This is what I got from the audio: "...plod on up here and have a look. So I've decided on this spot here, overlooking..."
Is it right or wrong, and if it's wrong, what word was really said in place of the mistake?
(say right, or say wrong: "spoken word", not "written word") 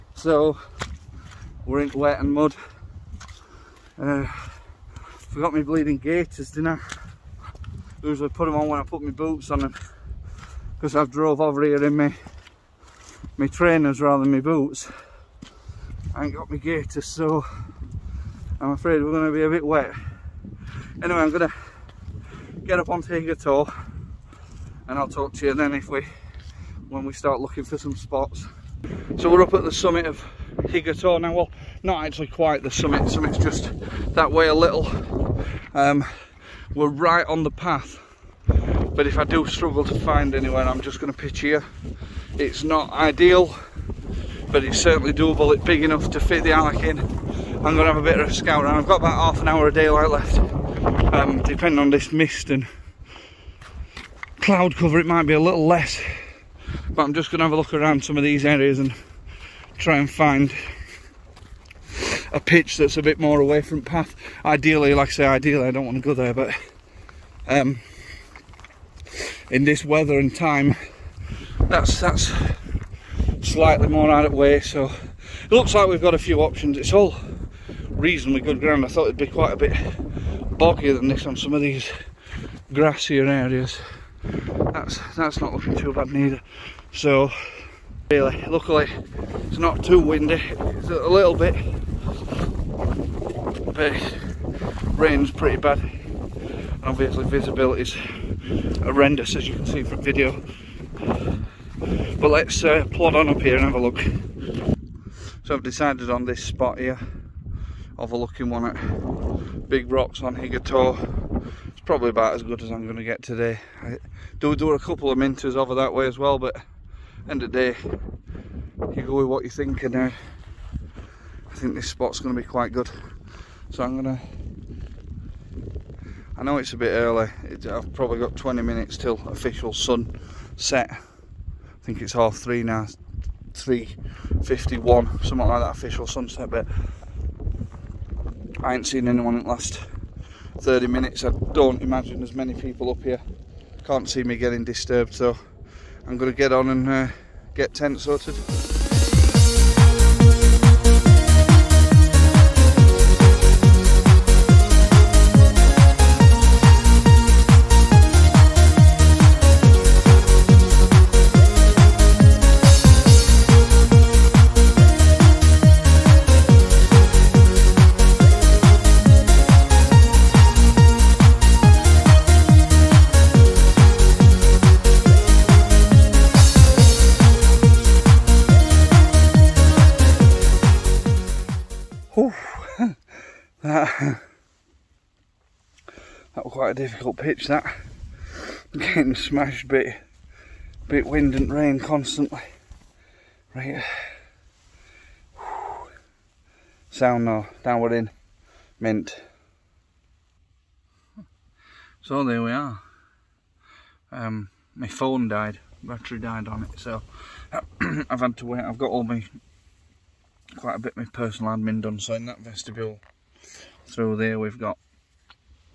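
right.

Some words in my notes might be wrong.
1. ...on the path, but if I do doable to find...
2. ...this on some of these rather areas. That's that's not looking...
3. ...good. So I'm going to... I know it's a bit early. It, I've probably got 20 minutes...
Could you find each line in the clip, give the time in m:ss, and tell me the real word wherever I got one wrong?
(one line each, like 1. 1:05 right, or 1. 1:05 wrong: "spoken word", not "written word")
1. 0:37 wrong: "struggle", not "doable"
2. 1:21 wrong: "grassier", not "rather"
3. 2:02 right.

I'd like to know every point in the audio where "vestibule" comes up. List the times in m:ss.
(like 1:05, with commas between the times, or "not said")
3:32.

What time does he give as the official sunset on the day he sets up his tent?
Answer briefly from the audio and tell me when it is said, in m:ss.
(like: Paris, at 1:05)
3:51, at 2:13.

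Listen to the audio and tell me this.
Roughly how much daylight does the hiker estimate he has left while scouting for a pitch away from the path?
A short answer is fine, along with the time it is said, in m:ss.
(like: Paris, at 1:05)
Half an hour, at 0:49.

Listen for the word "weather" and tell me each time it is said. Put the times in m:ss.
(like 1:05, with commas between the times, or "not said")
1:09.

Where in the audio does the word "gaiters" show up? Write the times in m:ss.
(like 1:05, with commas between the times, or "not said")
0:05, 0:16.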